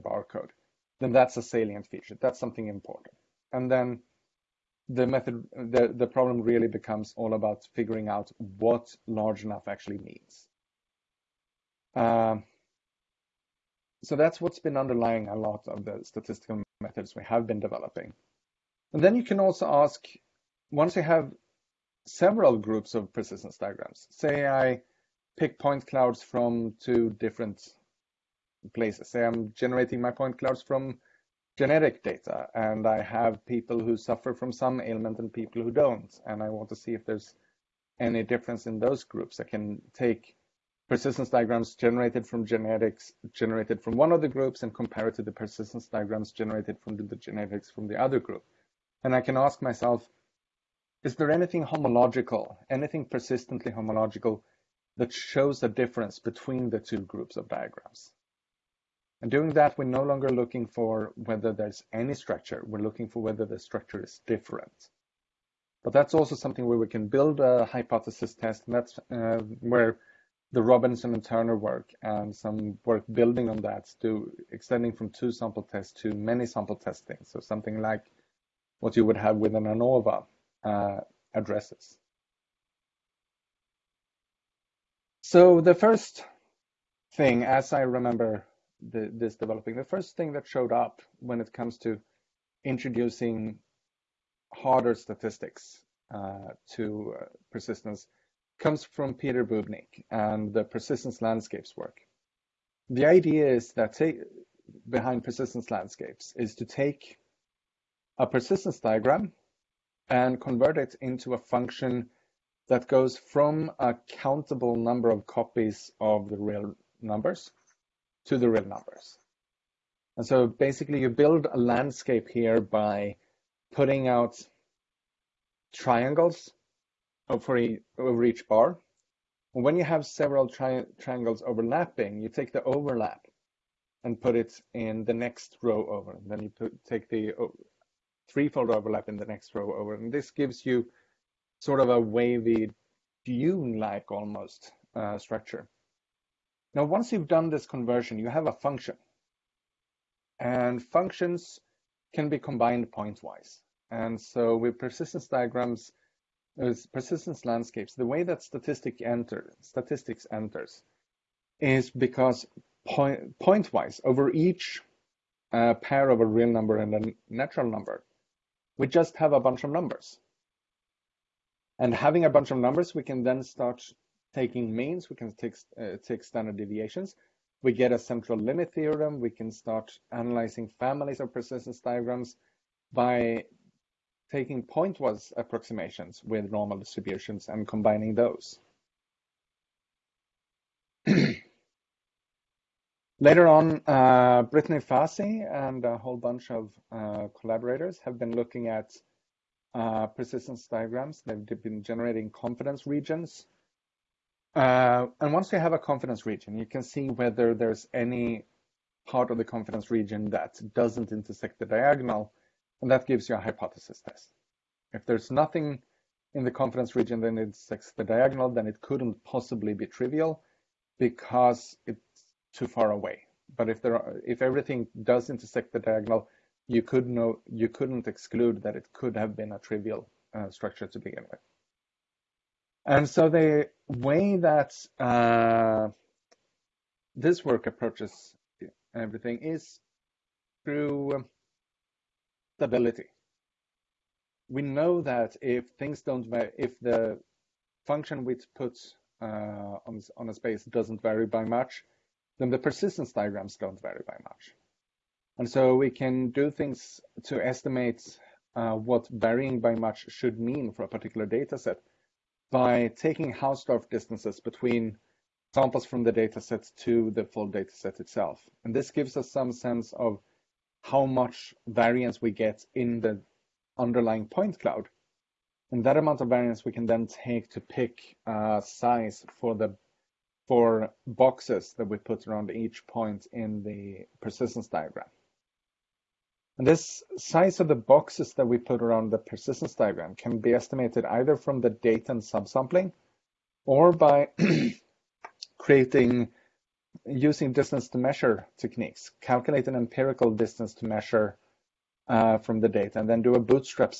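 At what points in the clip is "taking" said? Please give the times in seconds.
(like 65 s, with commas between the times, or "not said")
174 s, 184 s, 262 s.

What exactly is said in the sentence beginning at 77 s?
So something like what you would have with an ANOVA, uh, addresses.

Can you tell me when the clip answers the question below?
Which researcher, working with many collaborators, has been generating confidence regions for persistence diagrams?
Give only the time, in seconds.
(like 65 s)
194 s.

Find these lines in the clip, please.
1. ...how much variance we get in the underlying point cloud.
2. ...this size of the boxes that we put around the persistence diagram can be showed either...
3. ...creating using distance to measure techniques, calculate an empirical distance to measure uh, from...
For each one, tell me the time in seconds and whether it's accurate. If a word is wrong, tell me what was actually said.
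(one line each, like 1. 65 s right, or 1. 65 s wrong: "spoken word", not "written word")
1. 270 s right
2. 286 s wrong: "estimated", not "showed"
3. 295 s right.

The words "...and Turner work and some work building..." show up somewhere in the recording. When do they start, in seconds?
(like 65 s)
71 s.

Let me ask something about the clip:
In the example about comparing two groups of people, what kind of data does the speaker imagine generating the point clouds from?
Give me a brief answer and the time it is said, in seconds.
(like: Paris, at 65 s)
genetic data, at 31 s.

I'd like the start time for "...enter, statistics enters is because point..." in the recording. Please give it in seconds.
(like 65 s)
159 s.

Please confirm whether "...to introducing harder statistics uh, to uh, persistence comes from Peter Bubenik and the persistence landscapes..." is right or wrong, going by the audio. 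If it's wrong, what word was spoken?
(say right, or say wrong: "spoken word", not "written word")
right.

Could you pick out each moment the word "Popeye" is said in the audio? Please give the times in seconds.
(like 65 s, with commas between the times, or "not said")
not said.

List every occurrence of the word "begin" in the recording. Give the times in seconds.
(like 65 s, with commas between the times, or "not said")
230 s.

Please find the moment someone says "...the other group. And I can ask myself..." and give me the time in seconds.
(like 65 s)
47 s.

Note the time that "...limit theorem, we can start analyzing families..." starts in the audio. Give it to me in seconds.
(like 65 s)
178 s.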